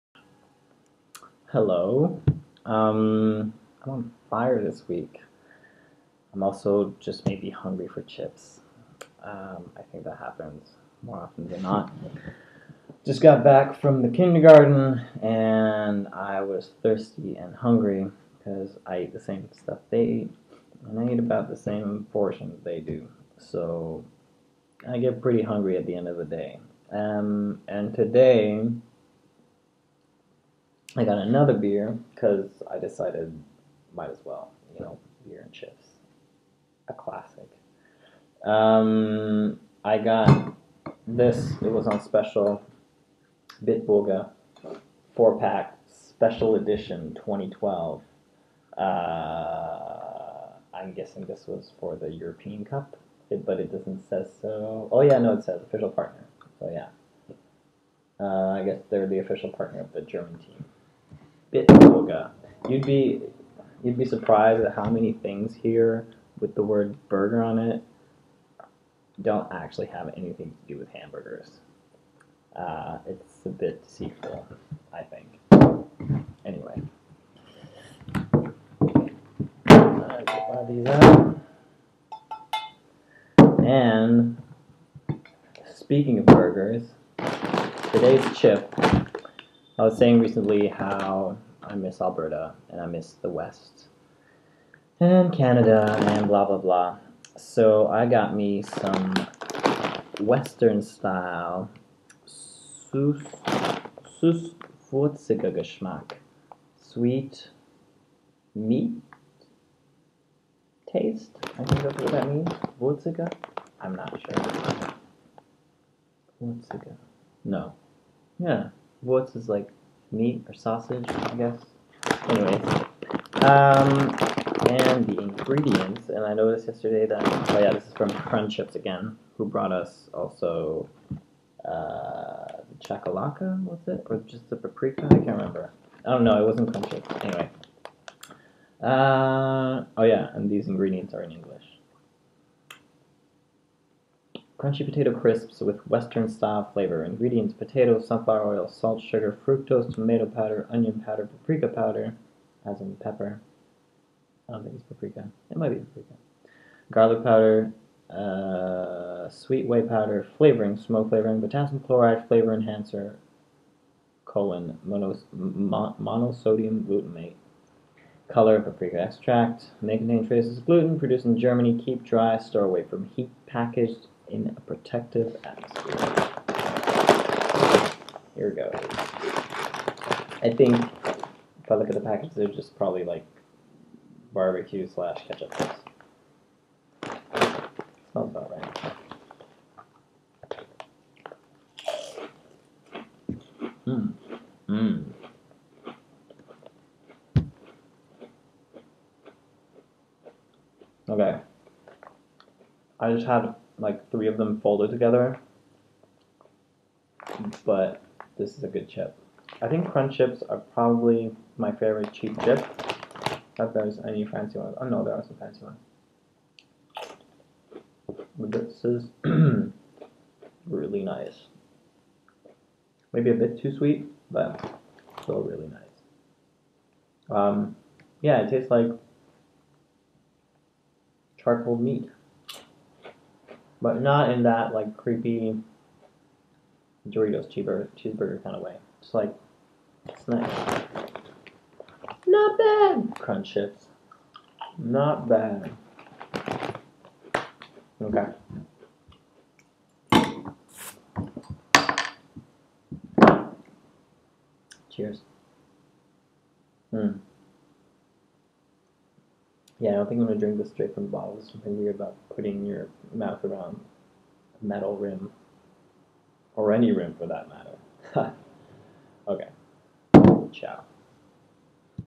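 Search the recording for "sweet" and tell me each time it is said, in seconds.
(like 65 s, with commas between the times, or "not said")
106 s, 159 s, 223 s.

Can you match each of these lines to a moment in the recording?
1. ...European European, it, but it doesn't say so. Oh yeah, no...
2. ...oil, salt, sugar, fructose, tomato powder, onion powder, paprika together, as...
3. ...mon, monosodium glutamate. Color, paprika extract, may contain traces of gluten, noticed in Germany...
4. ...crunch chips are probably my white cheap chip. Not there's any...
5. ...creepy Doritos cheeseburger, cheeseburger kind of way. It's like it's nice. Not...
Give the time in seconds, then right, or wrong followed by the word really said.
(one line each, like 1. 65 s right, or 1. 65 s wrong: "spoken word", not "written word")
1. 52 s wrong: "Cup", not "European"
2. 148 s wrong: "powder", not "together"
3. 165 s wrong: "produced", not "noticed"
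4. 209 s wrong: "favorite", not "white"
5. 234 s right.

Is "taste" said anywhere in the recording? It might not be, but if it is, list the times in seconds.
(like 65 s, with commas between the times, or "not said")
110 s, 228 s.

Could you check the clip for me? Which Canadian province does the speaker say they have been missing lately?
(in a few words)
Alberta.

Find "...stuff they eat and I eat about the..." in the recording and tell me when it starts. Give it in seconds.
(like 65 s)
19 s.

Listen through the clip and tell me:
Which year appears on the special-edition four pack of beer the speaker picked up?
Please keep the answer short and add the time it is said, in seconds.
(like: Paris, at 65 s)
2012, at 47 s.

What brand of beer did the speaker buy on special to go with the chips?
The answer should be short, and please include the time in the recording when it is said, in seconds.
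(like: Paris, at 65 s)
Bitburger, at 43 s.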